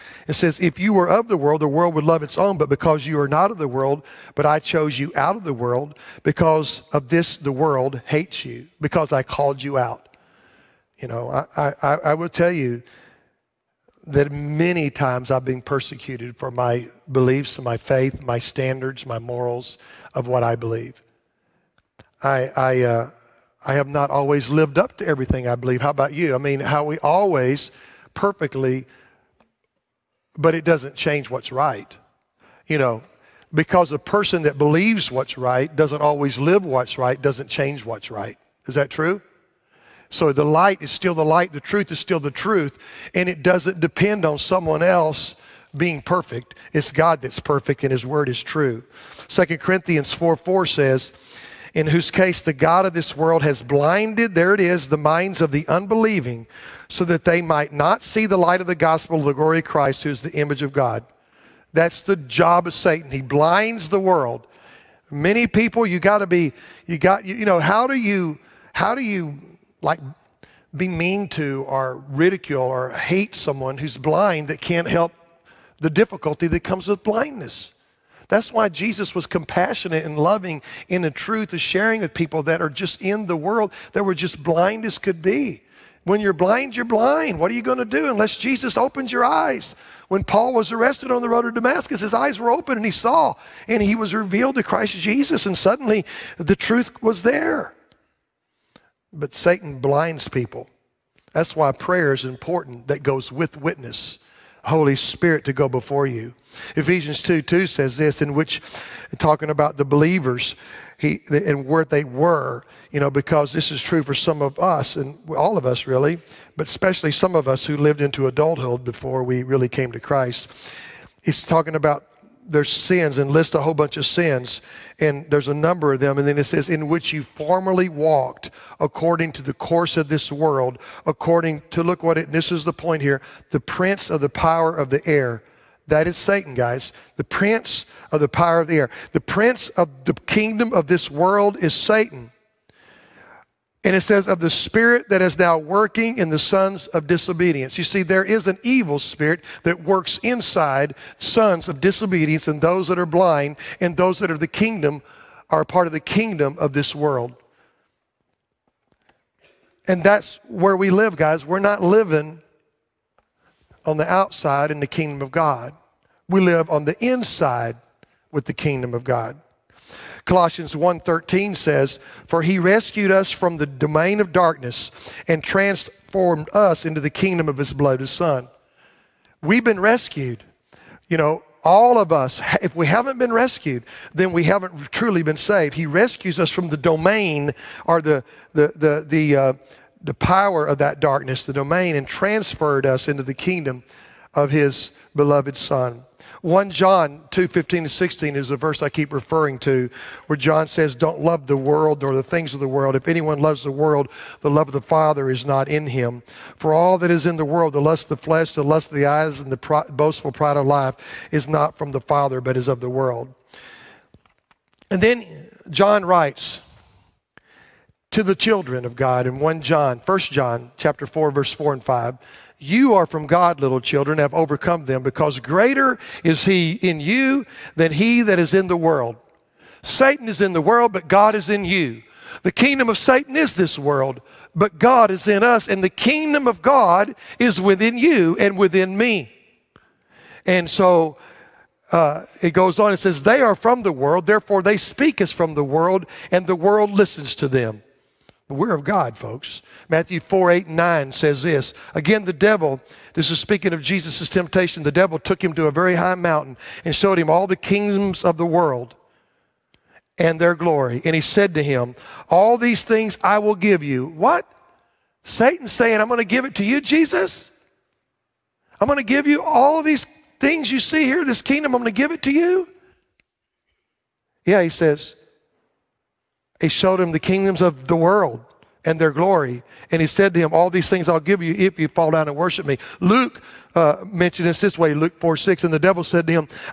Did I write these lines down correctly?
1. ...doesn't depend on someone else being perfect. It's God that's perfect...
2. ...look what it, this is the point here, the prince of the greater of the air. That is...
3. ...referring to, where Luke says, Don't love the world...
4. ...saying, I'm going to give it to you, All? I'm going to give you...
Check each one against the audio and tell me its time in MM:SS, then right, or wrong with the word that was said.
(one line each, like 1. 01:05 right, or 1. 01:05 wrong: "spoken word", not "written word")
1. 00:43 right
2. 02:11 wrong: "power", not "greater"
3. 03:19 wrong: "John", not "Luke"
4. 04:25 wrong: "Jesus", not "All".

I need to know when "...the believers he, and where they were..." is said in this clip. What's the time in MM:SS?
01:49.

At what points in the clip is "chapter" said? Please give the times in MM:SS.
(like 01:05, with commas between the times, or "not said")
03:40.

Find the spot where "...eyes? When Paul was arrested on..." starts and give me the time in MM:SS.
01:29.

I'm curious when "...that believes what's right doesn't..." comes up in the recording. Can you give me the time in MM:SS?
00:34.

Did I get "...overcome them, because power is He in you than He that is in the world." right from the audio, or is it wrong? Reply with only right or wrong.
wrong.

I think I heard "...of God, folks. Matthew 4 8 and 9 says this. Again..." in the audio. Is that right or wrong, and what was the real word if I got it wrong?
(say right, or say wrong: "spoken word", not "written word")
right.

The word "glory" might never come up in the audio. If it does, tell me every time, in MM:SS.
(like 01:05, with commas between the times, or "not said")
00:59, 04:20, 04:39.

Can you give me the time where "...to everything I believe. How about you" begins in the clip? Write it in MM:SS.
00:24.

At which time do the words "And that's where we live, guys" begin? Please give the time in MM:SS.
02:39.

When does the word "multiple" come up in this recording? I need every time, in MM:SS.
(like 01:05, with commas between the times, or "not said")
not said.